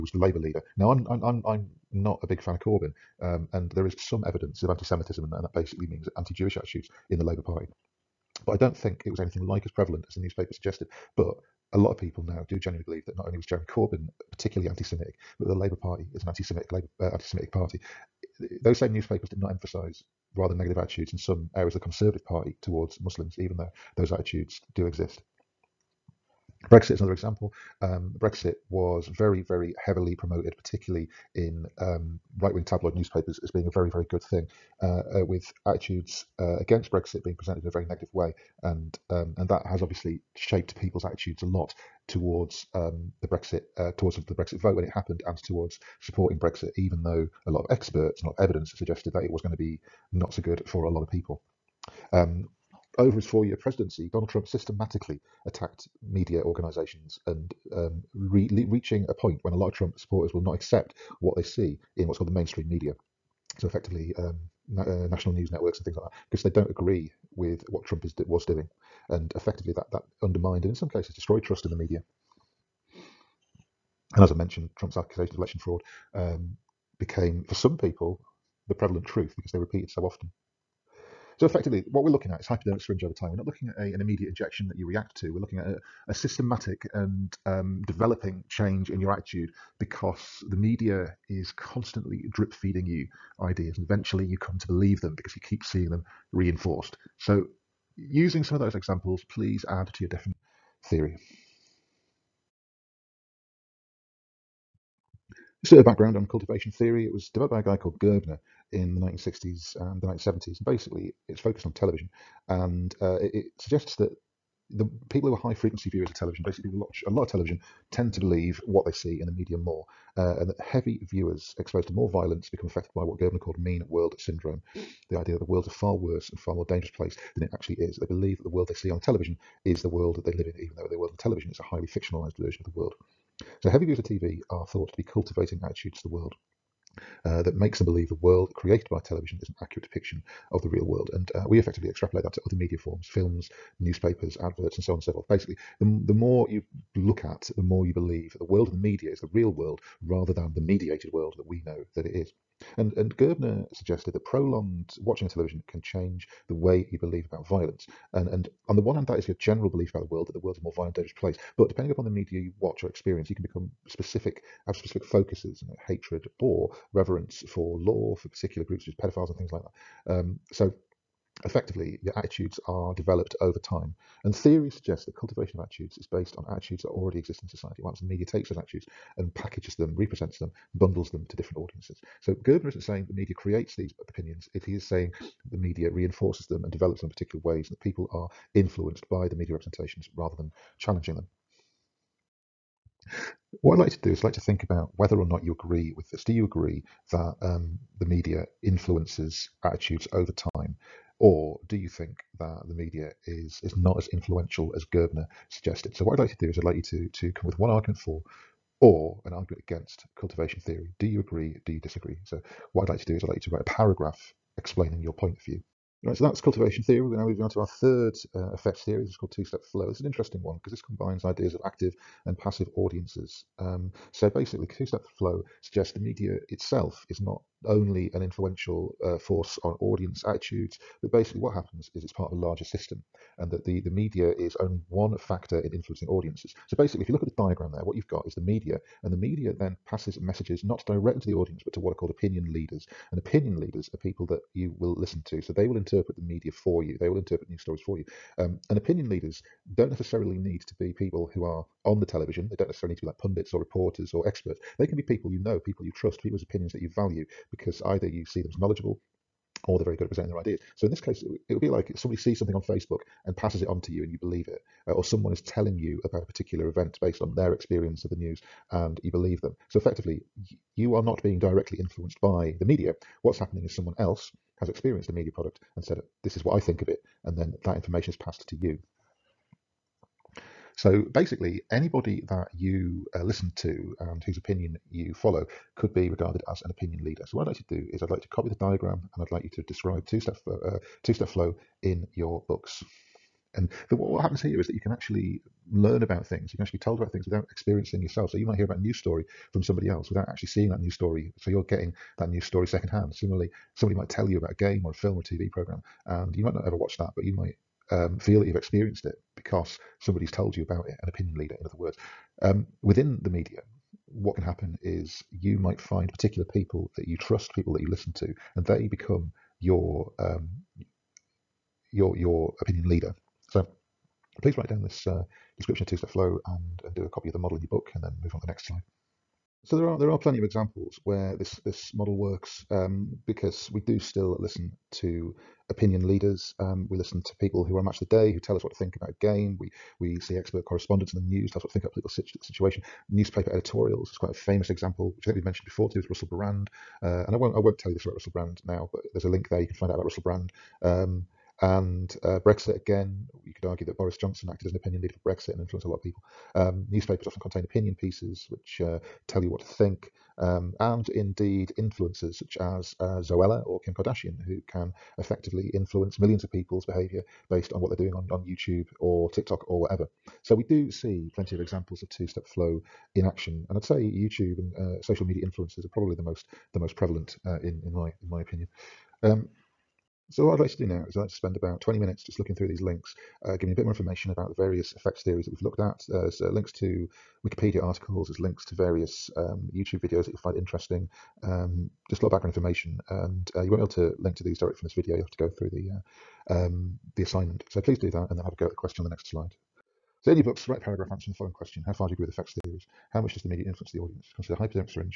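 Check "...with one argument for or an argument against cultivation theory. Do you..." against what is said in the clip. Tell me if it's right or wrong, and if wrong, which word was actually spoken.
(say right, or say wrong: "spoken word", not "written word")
right.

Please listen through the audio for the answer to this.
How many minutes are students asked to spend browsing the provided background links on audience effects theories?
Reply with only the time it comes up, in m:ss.
6:21.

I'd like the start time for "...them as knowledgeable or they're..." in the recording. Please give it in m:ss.
4:18.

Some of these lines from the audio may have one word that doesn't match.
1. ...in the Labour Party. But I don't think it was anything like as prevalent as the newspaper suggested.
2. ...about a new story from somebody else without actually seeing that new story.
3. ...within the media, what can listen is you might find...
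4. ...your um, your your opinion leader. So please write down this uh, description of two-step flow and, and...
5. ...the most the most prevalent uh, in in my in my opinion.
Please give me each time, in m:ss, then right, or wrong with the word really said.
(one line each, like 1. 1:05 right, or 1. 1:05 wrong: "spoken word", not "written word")
1. 0:07 right
2. 4:58 right
3. 5:12 wrong: "happen", not "listen"
4. 5:19 right
5. 6:16 right.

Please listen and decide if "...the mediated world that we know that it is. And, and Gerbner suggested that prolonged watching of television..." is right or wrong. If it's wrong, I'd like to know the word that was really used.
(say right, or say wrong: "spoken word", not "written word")
right.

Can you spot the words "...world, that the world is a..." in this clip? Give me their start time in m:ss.
2:40.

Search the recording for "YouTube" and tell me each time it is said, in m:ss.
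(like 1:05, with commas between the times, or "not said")
6:08, 6:14, 6:29.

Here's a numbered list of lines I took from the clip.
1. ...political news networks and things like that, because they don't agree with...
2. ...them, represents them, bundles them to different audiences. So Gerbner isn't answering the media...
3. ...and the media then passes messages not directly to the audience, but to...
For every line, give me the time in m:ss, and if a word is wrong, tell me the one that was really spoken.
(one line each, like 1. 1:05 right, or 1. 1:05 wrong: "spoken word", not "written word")
1. 1:05 wrong: "national", not "political"
2. 2:59 wrong: "saying", not "answering"
3. 3:59 right.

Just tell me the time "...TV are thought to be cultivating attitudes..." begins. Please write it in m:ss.
2:14.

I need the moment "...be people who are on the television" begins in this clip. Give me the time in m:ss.
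4:10.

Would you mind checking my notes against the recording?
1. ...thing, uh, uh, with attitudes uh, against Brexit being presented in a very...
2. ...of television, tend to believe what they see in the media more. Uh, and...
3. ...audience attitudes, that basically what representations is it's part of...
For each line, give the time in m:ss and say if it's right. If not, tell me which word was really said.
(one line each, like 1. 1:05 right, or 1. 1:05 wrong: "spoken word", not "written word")
1. 0:34 right
2. 1:57 right
3. 3:49 wrong: "happens", not "representations".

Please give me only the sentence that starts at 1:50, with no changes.
And basically, it's focused on television.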